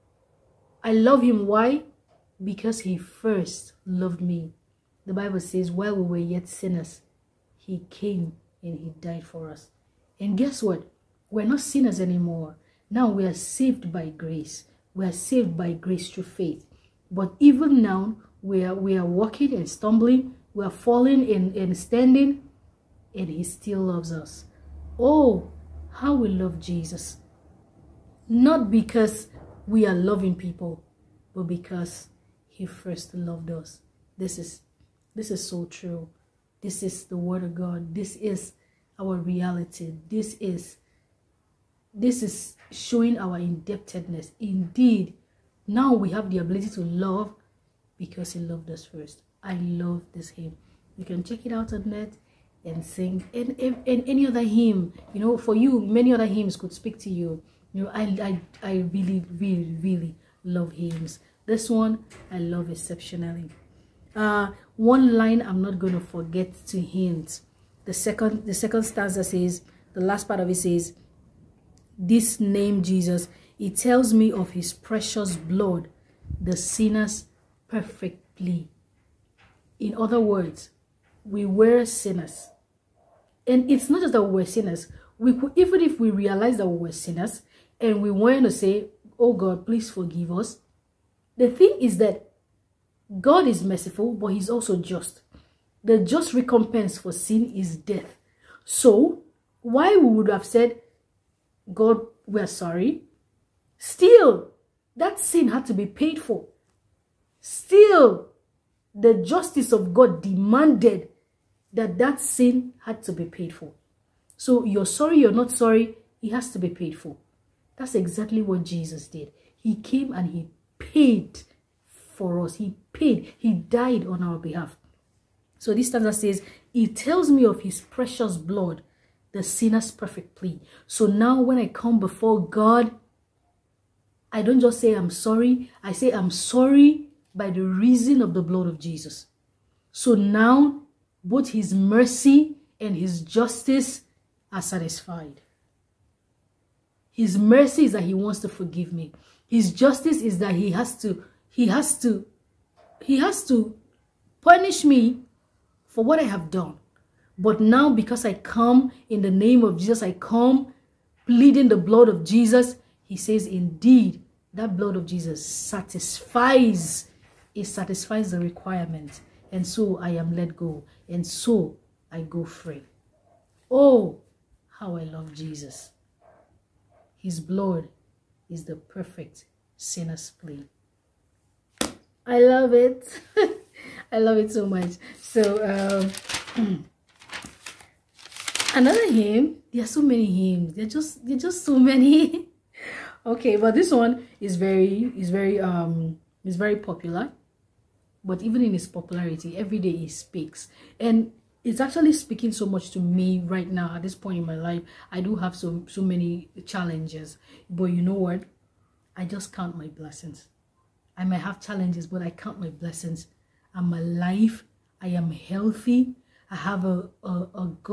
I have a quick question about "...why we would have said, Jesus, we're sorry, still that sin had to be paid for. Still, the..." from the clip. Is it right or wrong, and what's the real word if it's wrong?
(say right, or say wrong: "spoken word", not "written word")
wrong: "God", not "Jesus".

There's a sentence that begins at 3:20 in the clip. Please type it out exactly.
And it's actually speaking so much to me right now at this point in my life.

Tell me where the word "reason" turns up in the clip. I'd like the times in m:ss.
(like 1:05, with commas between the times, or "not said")
2:17.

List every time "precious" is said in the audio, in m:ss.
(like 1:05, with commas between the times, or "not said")
1:14, 2:07.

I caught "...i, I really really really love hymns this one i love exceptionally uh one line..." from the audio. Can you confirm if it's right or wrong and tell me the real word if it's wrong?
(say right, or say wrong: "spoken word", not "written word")
right.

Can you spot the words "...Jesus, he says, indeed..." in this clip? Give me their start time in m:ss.
2:42.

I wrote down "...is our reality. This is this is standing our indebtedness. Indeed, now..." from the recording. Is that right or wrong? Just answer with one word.
wrong.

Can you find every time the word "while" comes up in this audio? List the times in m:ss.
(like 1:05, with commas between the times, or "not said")
0:05.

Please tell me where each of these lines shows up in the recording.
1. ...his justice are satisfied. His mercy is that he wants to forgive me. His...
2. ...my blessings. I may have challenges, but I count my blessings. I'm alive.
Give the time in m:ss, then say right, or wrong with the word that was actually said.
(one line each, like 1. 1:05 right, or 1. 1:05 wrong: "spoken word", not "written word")
1. 2:22 right
2. 3:29 right.